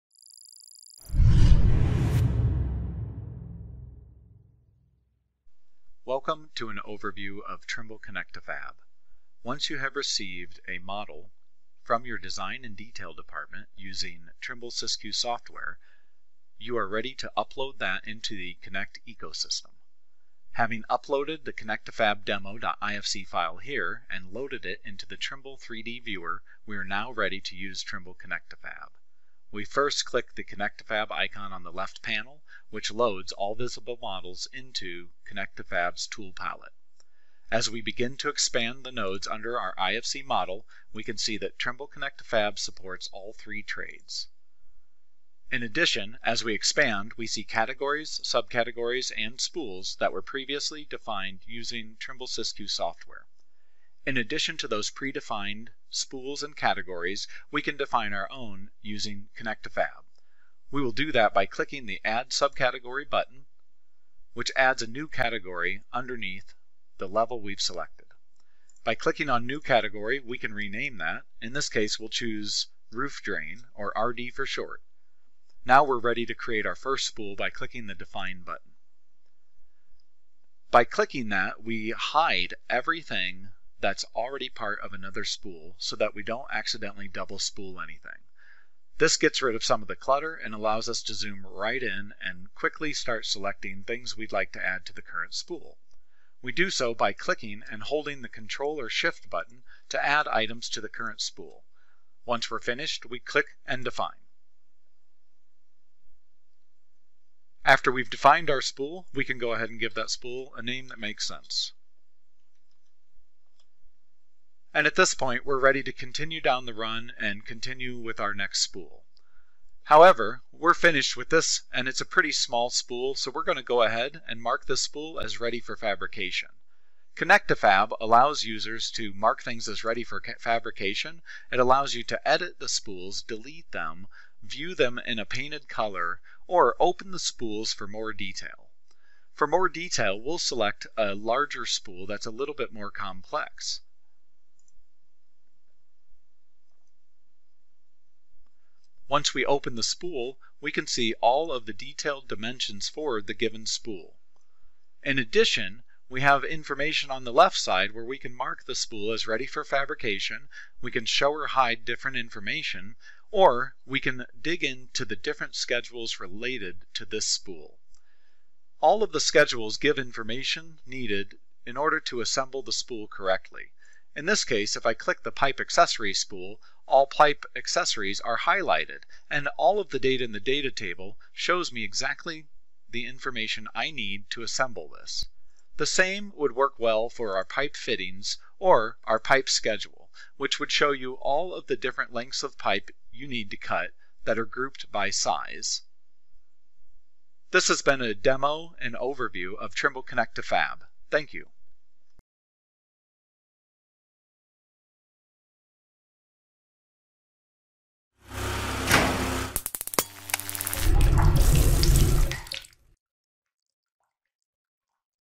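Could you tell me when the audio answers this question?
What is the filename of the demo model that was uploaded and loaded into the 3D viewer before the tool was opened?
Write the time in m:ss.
0:21.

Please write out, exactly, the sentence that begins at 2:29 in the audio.
Once we open the spool we can see all of the detailed dimensions for the given spool.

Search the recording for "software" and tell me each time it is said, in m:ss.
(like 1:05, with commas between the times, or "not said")
0:15, 0:52.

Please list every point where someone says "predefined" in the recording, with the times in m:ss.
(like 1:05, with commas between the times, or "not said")
0:54.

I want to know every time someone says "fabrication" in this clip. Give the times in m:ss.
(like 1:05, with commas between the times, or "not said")
2:05, 2:10, 2:39.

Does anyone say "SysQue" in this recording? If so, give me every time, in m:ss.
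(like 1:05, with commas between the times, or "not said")
0:14, 0:52.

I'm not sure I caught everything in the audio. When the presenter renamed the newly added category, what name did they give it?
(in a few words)
Roof Drain.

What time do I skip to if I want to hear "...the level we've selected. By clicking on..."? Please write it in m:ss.
1:06.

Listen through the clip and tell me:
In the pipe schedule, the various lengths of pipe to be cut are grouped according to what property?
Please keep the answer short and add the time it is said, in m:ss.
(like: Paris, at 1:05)
size, at 3:15.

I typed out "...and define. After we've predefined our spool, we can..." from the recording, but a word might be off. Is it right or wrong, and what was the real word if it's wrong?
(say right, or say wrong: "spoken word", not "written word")
wrong: "defined", not "predefined".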